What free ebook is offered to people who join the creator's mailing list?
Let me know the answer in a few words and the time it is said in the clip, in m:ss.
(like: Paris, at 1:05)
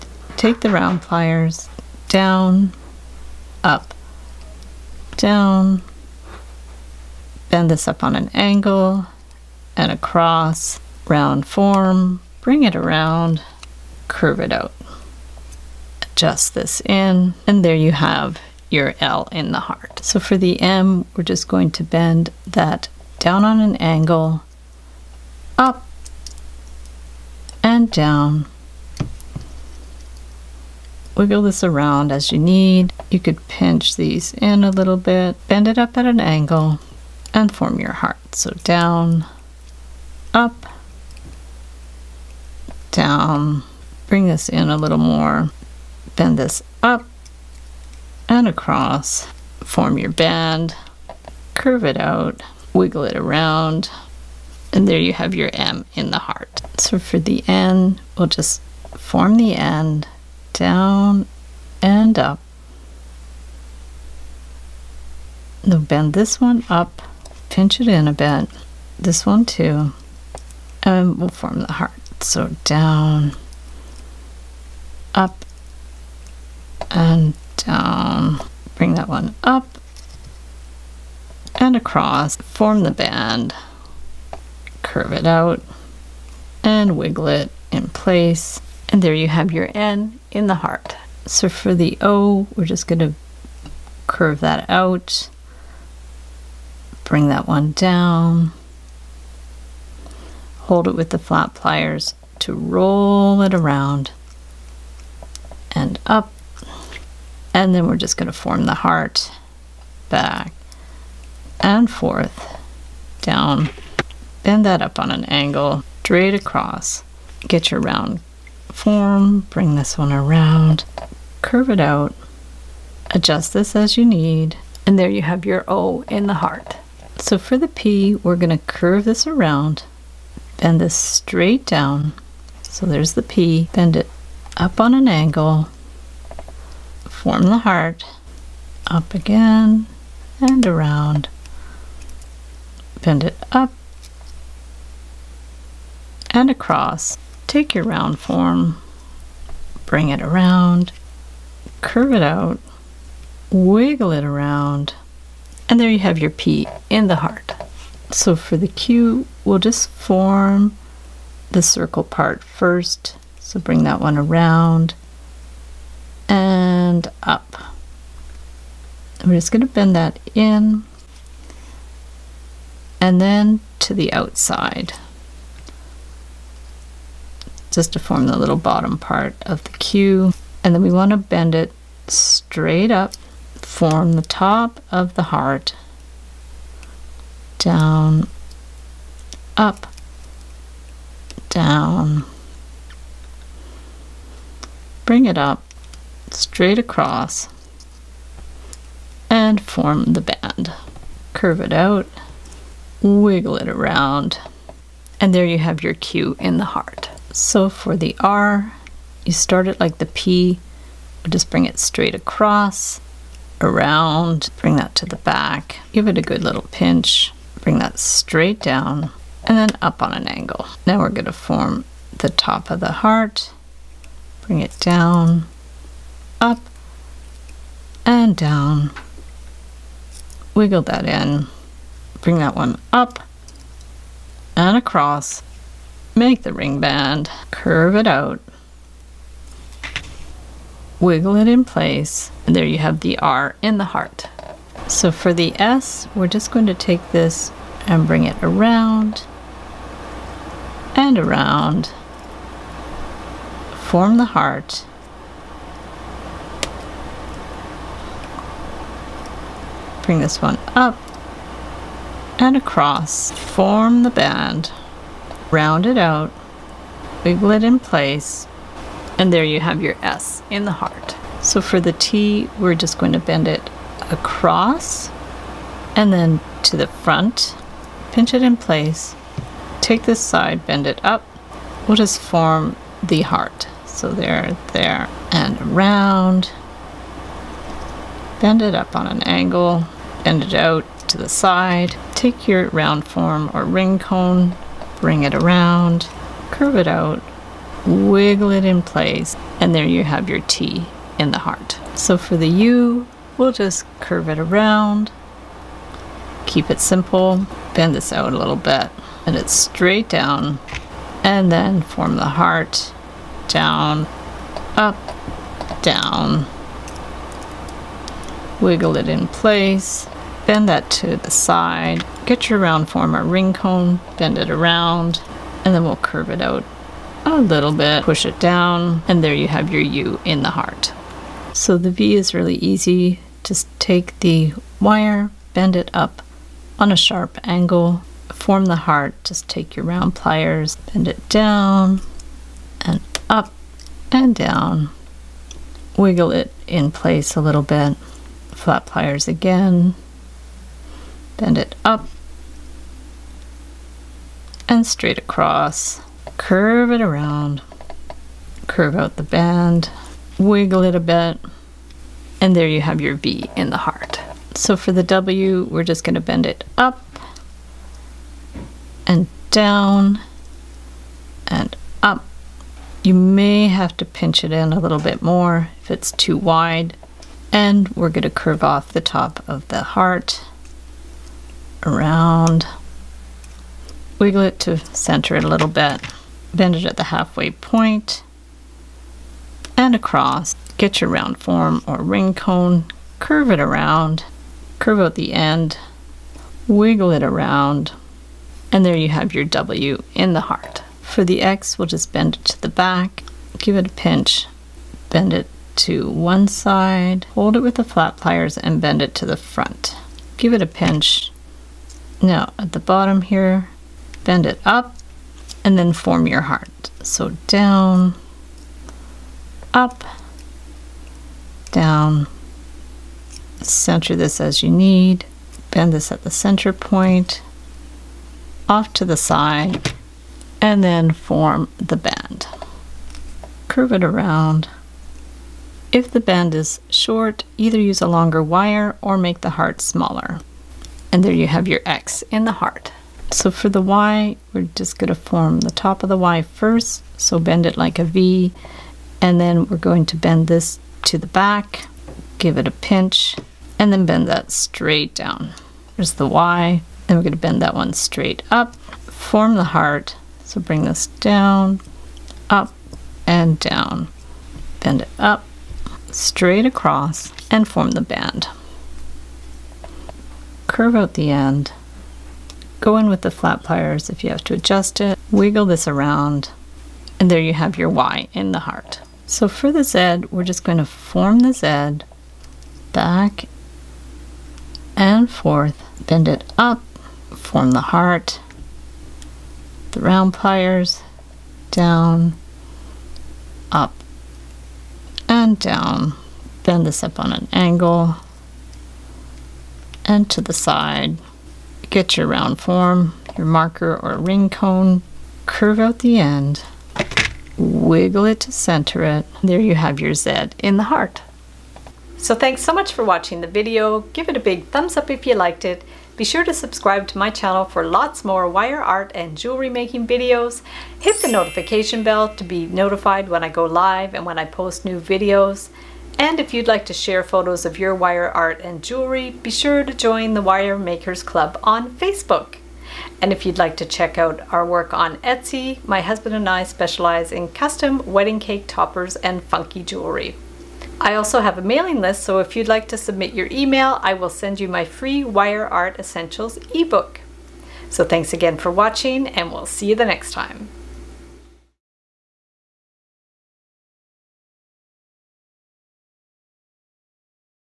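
Wire Art Essentials, at 9:05.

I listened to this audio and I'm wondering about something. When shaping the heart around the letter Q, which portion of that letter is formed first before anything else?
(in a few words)
The circle part.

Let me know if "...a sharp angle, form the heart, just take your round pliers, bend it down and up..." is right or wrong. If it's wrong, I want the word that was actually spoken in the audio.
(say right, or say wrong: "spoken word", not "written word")
right.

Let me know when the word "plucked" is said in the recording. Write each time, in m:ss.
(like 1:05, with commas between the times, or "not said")
not said.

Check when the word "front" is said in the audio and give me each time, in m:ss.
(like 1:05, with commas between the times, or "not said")
4:36, 6:49.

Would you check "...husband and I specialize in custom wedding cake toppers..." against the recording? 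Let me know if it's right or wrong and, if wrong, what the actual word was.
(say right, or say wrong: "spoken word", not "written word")
right.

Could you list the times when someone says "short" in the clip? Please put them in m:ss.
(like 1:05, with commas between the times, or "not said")
7:16.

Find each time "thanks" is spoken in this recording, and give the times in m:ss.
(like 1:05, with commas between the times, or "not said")
8:32, 9:08.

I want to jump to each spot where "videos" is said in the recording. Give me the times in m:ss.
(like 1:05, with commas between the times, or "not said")
8:33, 8:40, 8:44.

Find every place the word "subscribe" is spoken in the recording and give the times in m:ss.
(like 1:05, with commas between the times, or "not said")
8:36.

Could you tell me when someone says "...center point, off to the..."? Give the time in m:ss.
7:06.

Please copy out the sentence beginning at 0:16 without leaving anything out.
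Adjust this in, and there you have your L in the heart.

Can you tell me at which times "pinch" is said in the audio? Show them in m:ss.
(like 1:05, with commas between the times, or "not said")
0:33, 1:07, 3:36, 4:38, 6:14, 6:43, 6:50, 7:32.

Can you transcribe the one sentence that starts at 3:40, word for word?
Now we're going to form the top of the heart, bring it down, up and down.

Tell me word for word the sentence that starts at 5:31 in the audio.
So the V is really easy.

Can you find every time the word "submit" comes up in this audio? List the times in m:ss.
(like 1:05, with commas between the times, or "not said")
9:02.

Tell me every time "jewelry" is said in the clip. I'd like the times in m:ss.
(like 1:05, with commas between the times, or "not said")
8:39, 8:48, 8:59.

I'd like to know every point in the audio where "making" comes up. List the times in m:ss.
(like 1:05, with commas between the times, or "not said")
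8:39.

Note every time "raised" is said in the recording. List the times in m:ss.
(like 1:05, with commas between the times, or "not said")
not said.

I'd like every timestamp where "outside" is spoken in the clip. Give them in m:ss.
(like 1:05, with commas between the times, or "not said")
2:54.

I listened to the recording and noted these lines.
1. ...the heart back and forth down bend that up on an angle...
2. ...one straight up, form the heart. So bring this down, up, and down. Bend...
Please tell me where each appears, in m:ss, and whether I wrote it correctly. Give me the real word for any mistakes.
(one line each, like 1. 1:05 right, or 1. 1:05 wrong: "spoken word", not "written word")
1. 1:48 right
2. 7:37 right.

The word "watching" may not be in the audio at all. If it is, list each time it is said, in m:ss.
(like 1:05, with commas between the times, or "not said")
8:33, 9:08.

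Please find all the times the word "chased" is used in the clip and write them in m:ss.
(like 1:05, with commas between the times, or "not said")
not said.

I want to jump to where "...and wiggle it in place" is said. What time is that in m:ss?
1:26.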